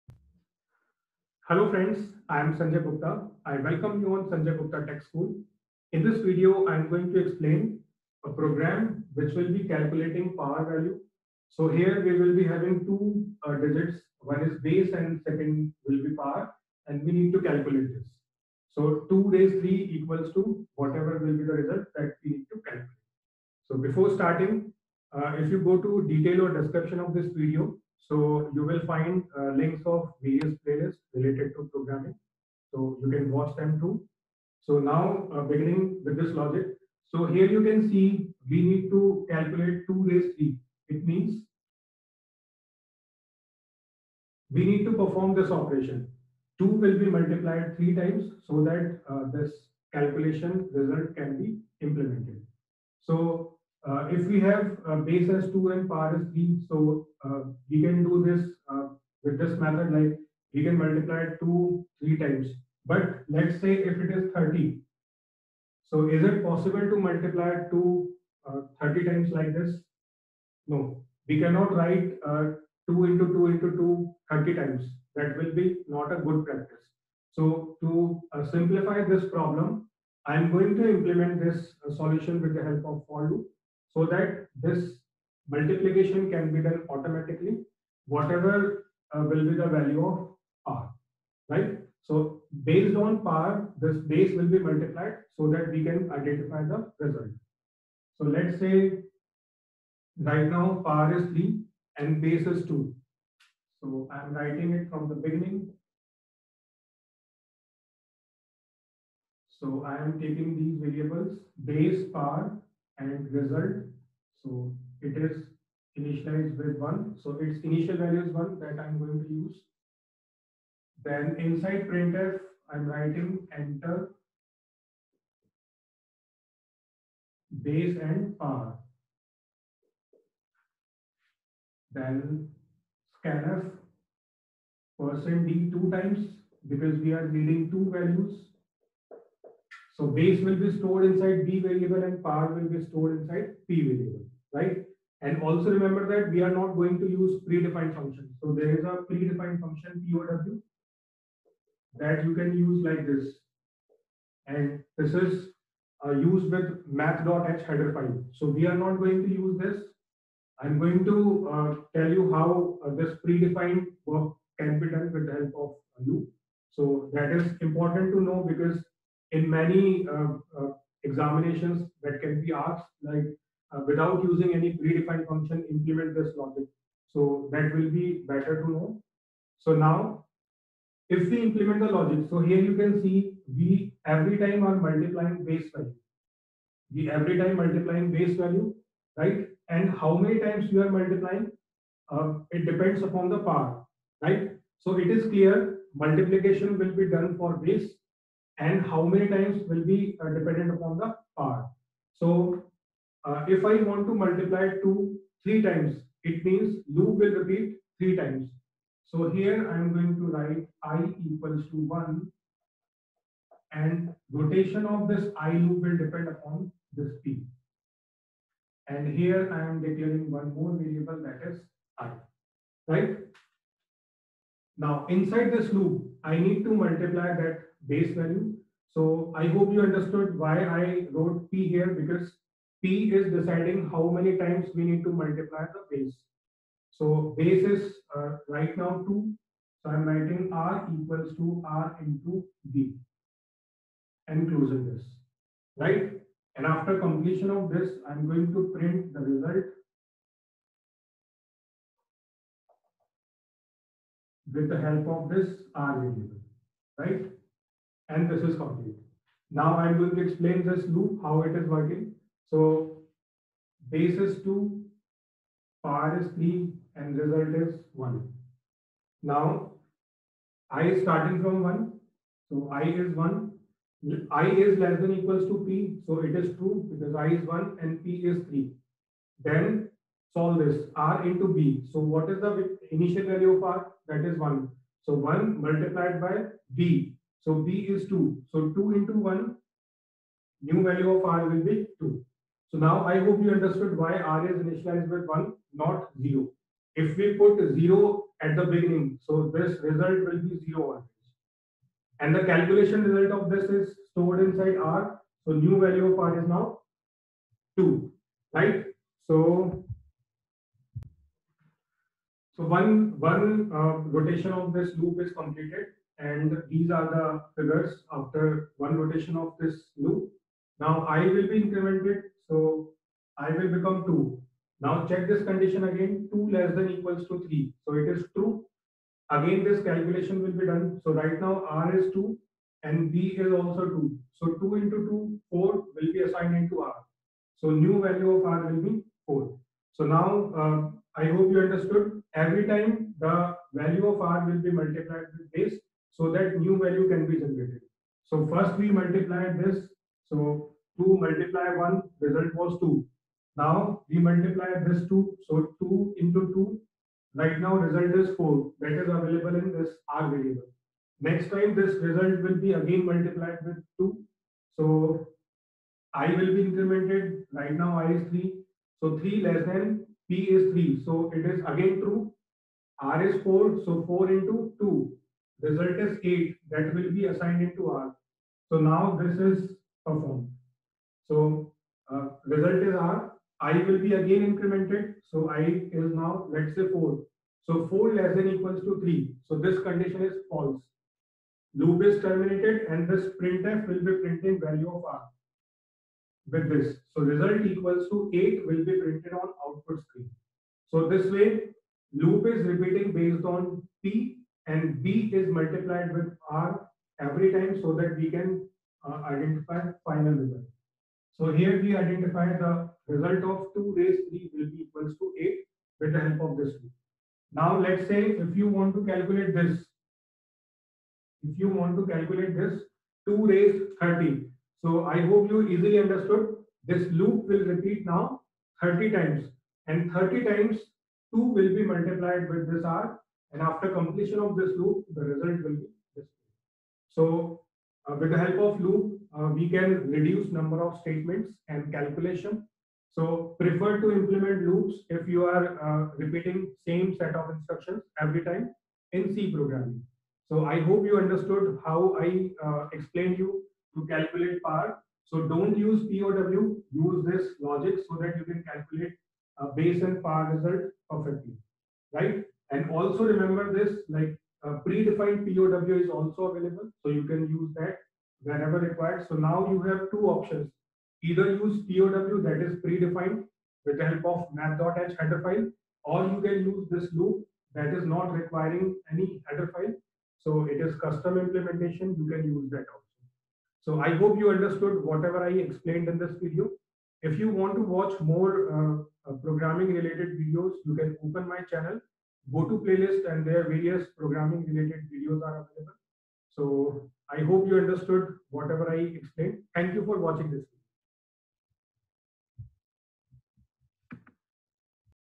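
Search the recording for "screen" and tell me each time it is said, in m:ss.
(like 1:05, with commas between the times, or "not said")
6:40.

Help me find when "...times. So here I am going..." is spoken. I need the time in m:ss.
3:28.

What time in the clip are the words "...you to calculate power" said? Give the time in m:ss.
7:33.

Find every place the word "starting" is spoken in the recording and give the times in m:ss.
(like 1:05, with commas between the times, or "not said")
0:24, 4:31.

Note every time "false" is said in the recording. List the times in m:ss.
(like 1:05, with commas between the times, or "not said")
6:30.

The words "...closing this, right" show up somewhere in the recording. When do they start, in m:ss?
4:04.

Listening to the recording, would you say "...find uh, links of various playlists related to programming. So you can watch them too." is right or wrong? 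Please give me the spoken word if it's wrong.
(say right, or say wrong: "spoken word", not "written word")
right.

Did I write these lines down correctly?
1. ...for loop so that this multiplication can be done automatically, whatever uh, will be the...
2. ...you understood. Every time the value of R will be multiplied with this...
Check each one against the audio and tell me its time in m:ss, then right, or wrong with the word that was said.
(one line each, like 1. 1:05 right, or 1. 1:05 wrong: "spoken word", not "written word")
1. 1:23 right
2. 5:41 right.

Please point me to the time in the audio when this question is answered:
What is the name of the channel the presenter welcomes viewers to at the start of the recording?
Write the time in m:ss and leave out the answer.
0:04.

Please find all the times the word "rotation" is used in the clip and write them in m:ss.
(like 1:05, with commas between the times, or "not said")
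3:34, 5:14, 5:18.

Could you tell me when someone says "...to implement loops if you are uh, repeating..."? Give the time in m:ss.
7:23.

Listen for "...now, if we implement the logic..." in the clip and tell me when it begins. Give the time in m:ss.
2:59.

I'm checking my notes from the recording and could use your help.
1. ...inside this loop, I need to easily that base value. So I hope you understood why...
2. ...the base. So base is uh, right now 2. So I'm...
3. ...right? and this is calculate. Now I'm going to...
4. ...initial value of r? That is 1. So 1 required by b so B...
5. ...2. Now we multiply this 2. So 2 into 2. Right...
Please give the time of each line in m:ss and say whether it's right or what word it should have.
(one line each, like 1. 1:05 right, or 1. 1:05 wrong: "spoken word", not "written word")
1. 3:45 wrong: "multiply", not "easily"
2. 3:55 right
3. 4:16 wrong: "complete", not "calculate"
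4. 4:42 wrong: "multiplied", not "required"
5. 5:52 right.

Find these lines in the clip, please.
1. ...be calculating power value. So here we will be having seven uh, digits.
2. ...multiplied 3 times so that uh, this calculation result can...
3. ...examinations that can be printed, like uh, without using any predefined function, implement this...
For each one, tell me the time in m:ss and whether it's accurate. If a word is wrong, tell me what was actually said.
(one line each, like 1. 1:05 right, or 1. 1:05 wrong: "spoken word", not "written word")
1. 0:09 wrong: "two", not "seven"
2. 0:47 right
3. 2:51 wrong: "asked", not "printed".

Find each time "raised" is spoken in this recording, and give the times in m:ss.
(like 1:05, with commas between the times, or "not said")
0:19, 0:40, 6:53, 7:03.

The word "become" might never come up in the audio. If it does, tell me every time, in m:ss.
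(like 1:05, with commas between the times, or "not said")
5:23.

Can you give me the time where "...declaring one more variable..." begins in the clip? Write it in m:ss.
3:39.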